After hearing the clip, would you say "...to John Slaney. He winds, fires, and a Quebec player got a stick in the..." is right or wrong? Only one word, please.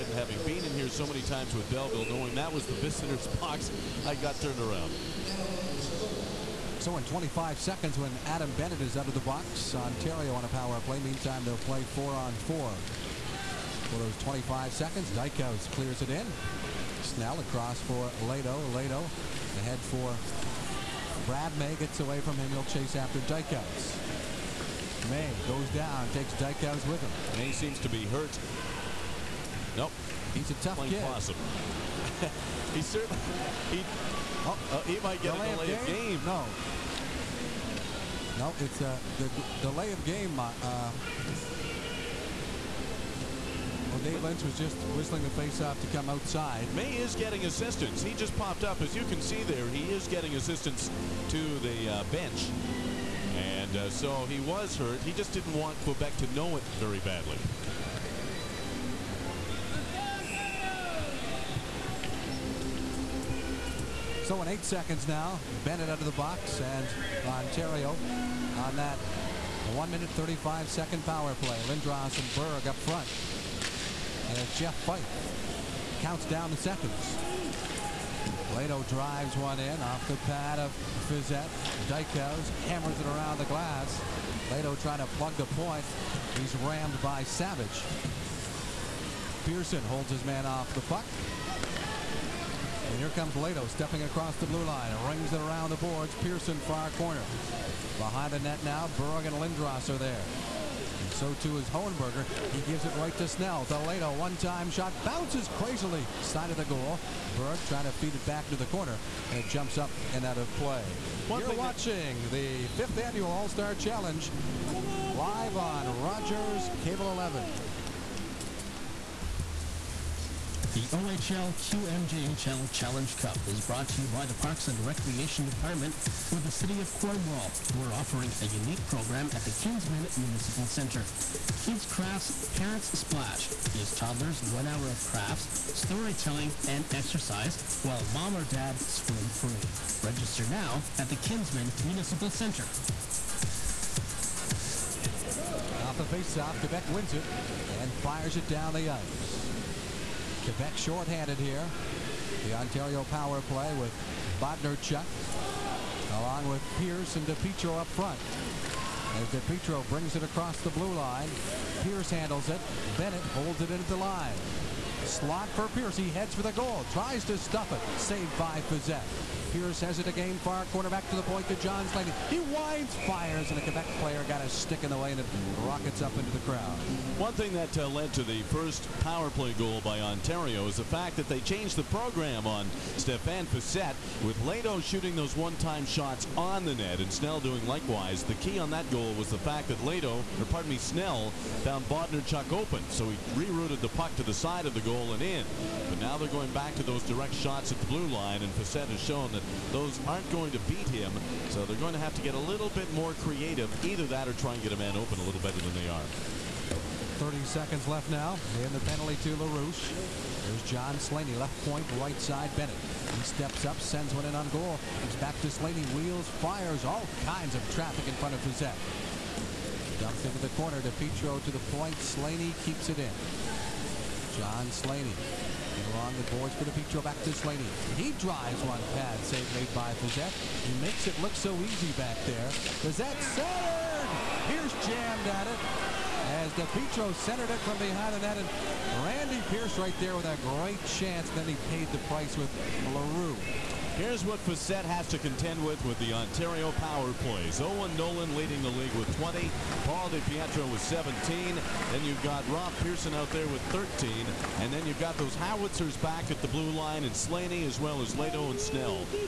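right.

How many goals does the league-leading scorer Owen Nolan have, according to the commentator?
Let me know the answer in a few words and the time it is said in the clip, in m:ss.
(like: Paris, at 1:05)
20, at 4:09.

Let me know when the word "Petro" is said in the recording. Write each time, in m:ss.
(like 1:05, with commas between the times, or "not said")
3:40.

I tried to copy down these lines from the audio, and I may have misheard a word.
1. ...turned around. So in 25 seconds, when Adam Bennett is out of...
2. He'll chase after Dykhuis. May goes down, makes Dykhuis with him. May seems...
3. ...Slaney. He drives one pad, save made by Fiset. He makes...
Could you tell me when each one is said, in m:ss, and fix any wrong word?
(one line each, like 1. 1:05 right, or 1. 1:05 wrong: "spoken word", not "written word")
1. 0:04 right
2. 0:22 wrong: "takes", not "makes"
3. 3:47 right.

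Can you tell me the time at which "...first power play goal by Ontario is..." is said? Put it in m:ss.
2:58.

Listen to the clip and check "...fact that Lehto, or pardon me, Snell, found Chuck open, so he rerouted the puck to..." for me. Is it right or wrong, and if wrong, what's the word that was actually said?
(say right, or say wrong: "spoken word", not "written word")
right.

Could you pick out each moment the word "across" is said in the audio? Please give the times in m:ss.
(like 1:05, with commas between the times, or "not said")
0:17, 1:34, 2:40.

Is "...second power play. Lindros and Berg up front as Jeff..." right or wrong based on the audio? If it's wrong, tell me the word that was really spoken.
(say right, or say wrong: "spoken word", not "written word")
right.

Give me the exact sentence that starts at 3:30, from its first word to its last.
There's John Slaney, left point, right side Bennett.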